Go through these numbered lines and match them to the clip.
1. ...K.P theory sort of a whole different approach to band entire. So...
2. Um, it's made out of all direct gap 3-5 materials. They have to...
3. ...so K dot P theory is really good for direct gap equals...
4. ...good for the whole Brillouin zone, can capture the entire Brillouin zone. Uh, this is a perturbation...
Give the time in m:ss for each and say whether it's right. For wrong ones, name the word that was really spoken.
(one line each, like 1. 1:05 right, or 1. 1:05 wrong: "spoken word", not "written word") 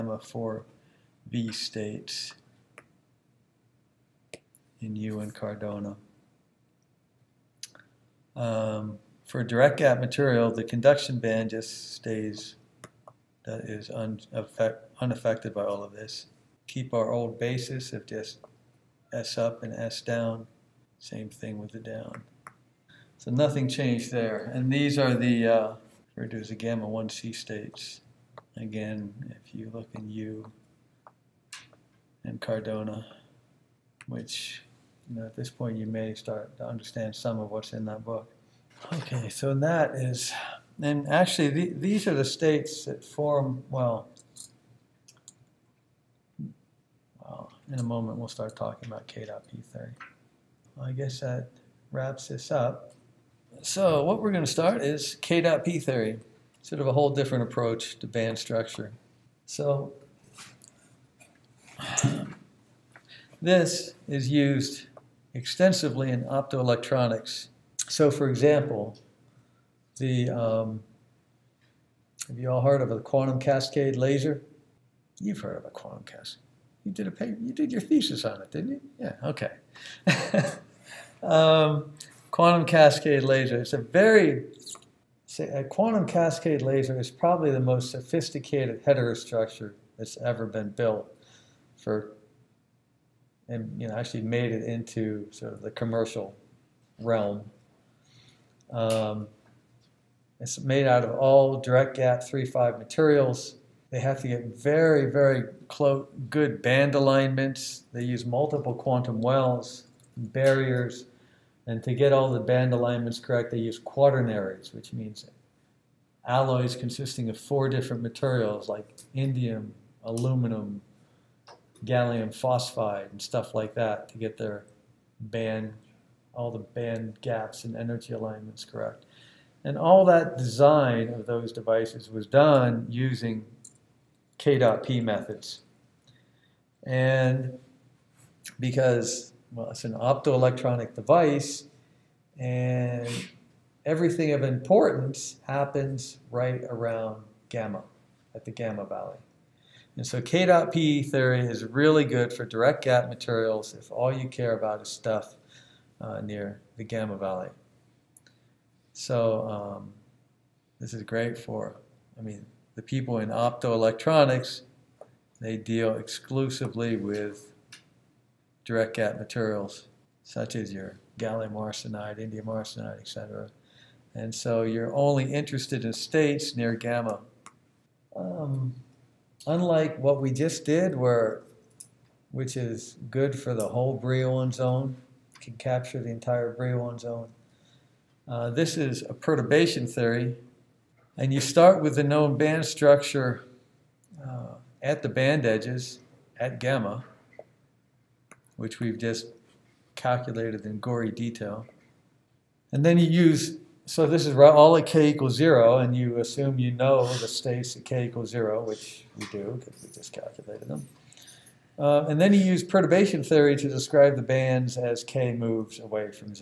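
1. 0:55 wrong: "structure", not "entire"
2. 1:38 right
3. 2:30 wrong: "materials", not "equals"
4. 3:03 right.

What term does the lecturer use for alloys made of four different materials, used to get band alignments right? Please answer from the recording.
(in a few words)
quaternaries.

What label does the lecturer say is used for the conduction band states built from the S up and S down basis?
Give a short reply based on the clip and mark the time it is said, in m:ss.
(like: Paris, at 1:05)
gamma 1C states, at 0:26.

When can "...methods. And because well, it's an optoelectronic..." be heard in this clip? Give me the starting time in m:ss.
2:14.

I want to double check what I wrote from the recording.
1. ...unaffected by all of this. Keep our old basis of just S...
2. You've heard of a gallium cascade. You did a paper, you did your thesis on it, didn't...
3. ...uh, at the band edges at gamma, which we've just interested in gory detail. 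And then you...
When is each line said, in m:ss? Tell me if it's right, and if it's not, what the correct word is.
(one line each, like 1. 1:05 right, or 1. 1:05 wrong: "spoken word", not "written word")
1. 0:14 right
2. 1:15 wrong: "quantum", not "gallium"
3. 3:14 wrong: "calculated", not "interested".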